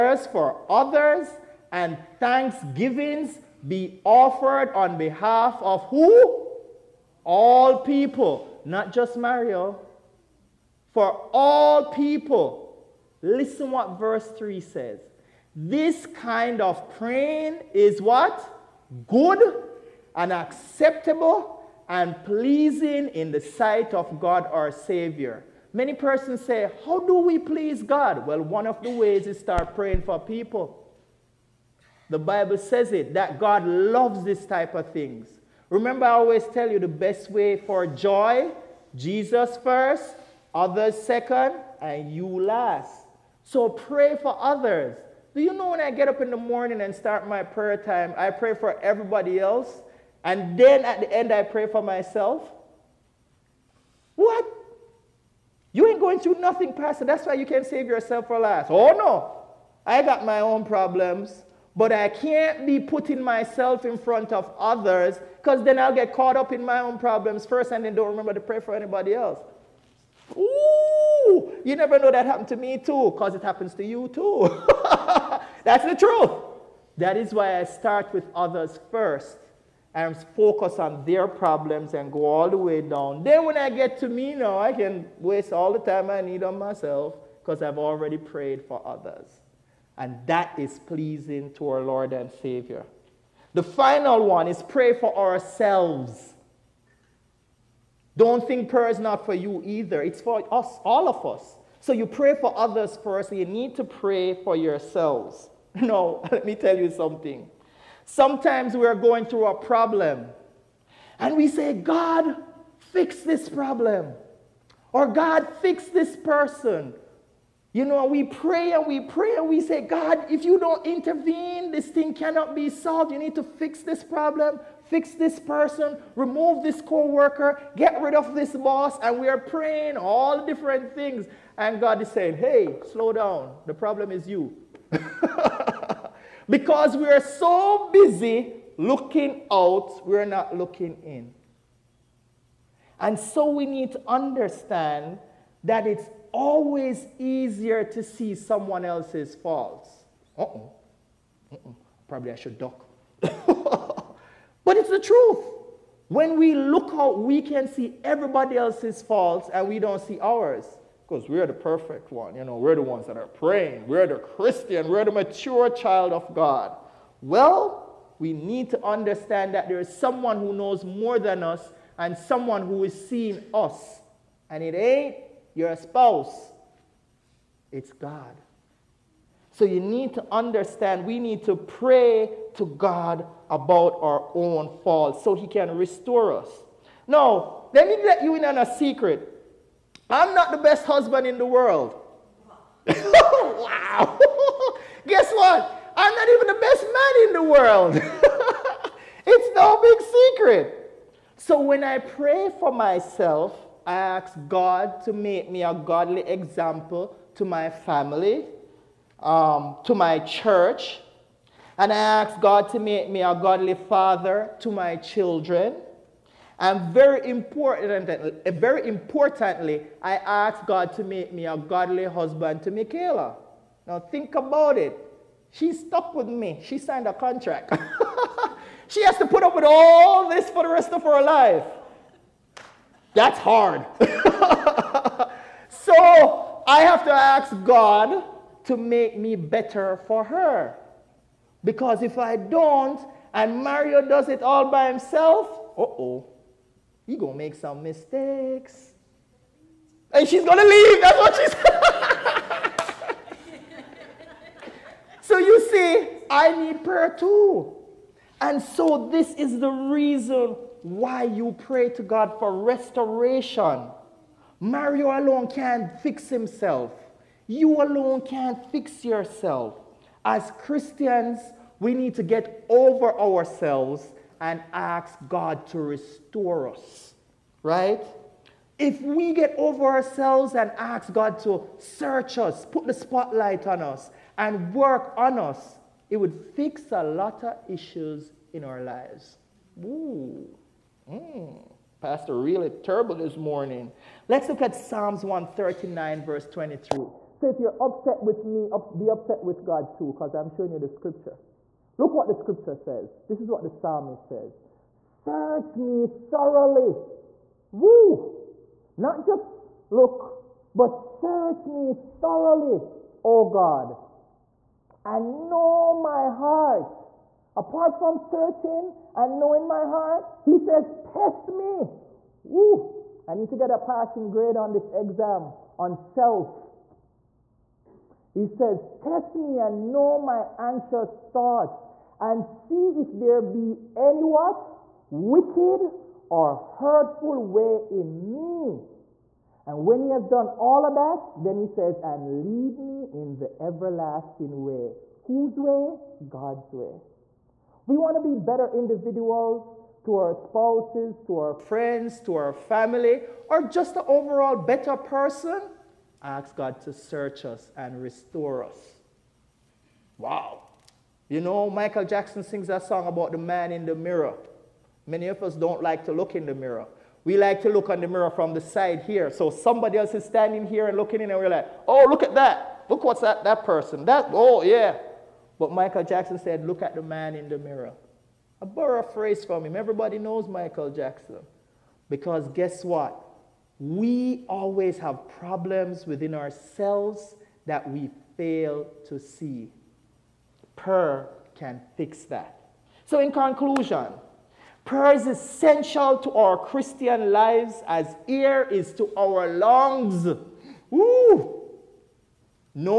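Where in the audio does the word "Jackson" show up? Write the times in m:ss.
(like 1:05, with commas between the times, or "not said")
6:02, 6:16, 6:20.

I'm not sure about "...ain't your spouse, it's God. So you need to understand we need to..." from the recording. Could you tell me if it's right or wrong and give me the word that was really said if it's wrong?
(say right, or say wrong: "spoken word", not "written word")
right.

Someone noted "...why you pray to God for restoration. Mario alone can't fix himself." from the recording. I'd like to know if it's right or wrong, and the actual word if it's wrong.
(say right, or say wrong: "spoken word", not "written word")
right.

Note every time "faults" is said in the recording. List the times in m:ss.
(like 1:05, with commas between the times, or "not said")
2:29, 2:39, 3:04.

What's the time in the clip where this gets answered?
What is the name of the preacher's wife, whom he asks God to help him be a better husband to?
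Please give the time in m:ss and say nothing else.
3:42.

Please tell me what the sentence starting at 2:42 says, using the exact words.
You know, we're the ones that are praying.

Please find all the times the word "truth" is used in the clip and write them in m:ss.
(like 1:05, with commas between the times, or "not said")
1:15, 2:34.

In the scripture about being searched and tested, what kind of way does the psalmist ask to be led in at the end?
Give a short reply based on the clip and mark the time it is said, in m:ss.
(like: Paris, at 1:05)
the everlasting way, at 5:43.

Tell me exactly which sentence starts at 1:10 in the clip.
Ooh, you never know that happened to me too, because it happens to you too.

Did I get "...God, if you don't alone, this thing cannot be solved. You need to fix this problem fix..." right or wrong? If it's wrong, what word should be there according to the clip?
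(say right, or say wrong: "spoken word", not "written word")
wrong: "intervene", not "alone".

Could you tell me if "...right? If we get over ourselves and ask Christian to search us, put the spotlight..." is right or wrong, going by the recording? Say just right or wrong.
wrong.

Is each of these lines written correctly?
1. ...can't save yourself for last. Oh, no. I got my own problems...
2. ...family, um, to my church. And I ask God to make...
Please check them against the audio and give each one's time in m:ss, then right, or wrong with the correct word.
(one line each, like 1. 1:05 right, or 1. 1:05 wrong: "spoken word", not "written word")
1. 0:57 right
2. 3:27 right.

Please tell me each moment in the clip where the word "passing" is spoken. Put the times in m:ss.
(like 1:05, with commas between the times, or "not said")
5:23.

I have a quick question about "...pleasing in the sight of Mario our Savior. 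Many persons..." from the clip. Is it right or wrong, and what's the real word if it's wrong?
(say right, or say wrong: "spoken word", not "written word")
wrong: "God", not "Mario".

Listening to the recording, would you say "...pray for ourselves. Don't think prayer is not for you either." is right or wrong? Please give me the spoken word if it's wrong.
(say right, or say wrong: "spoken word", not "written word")
right.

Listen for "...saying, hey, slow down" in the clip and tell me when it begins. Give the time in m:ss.
2:12.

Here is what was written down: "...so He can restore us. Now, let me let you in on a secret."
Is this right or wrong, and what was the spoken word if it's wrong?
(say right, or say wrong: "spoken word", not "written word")
right.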